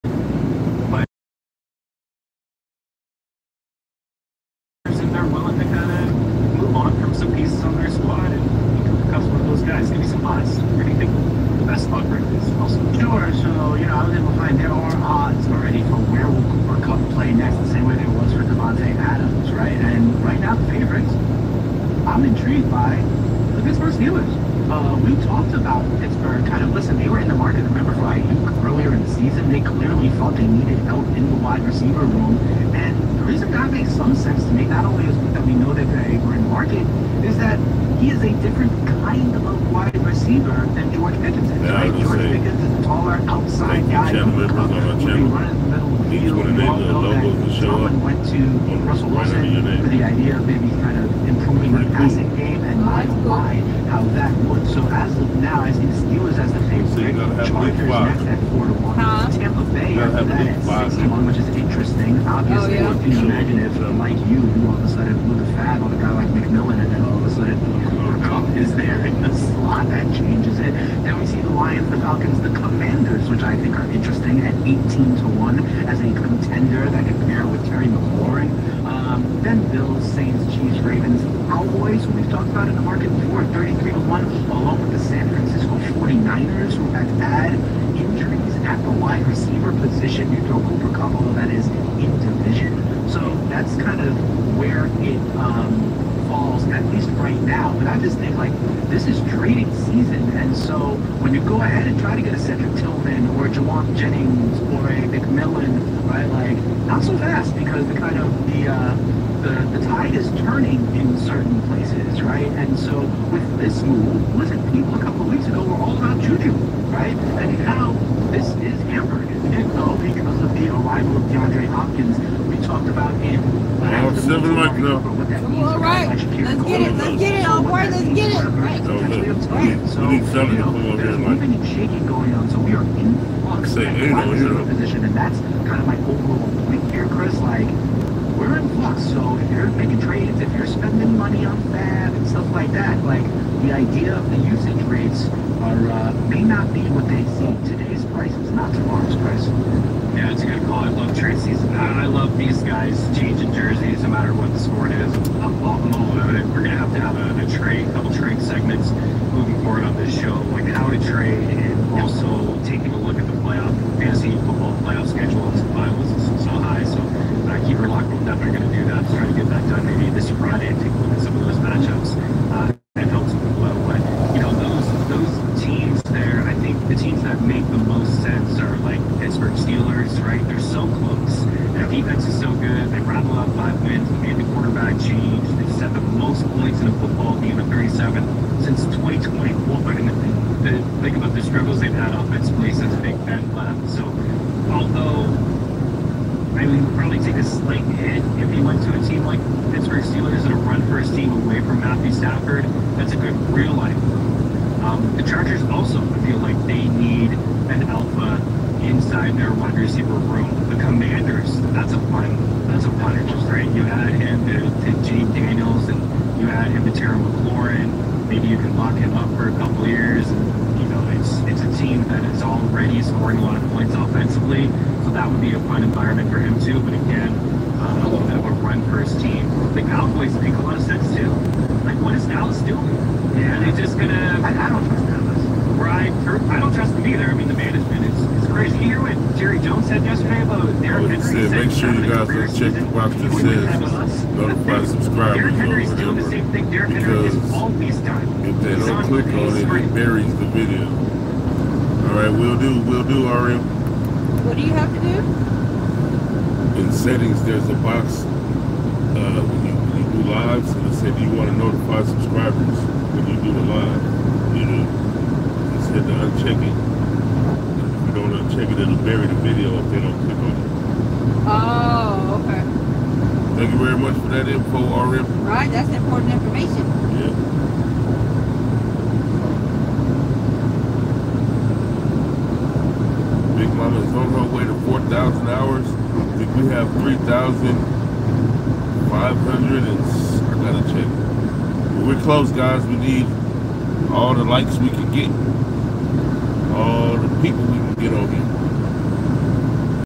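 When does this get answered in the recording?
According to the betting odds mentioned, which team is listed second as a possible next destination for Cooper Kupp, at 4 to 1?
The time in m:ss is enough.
0:57.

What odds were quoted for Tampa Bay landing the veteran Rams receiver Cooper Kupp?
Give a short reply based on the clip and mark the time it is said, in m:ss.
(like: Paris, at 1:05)
6 to 1, at 1:00.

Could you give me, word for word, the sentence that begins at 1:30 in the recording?
You throw Cooper Kupp, although that is in division.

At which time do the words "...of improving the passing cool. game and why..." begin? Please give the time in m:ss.
0:50.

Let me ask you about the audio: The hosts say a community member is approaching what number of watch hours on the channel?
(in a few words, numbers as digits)
4,000.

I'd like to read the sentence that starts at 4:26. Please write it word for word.
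If you don't uh, check it, it'll bury the video if they don't click on it.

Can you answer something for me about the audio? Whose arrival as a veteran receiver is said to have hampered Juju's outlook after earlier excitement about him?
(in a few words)
DeAndre Hopkins.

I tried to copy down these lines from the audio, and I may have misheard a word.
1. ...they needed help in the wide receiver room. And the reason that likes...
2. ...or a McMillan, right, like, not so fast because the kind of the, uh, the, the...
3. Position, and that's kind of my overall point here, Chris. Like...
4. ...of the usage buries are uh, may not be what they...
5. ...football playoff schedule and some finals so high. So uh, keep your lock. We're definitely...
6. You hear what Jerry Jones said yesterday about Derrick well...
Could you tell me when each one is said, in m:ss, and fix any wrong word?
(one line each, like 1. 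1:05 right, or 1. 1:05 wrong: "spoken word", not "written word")
1. 0:30 wrong: "makes", not "likes"
2. 1:44 right
3. 2:14 right
4. 2:24 wrong: "rates", not "buries"
5. 2:44 right
6. 3:58 right.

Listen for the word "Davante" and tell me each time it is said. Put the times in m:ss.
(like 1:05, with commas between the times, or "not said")
0:18.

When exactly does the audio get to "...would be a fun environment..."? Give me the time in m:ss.
3:45.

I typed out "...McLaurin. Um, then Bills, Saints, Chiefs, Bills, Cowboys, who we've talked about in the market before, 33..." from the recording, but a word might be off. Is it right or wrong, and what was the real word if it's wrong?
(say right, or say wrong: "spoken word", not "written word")
wrong: "Ravens", not "Bills".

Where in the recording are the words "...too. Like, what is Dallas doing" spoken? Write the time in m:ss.
3:51.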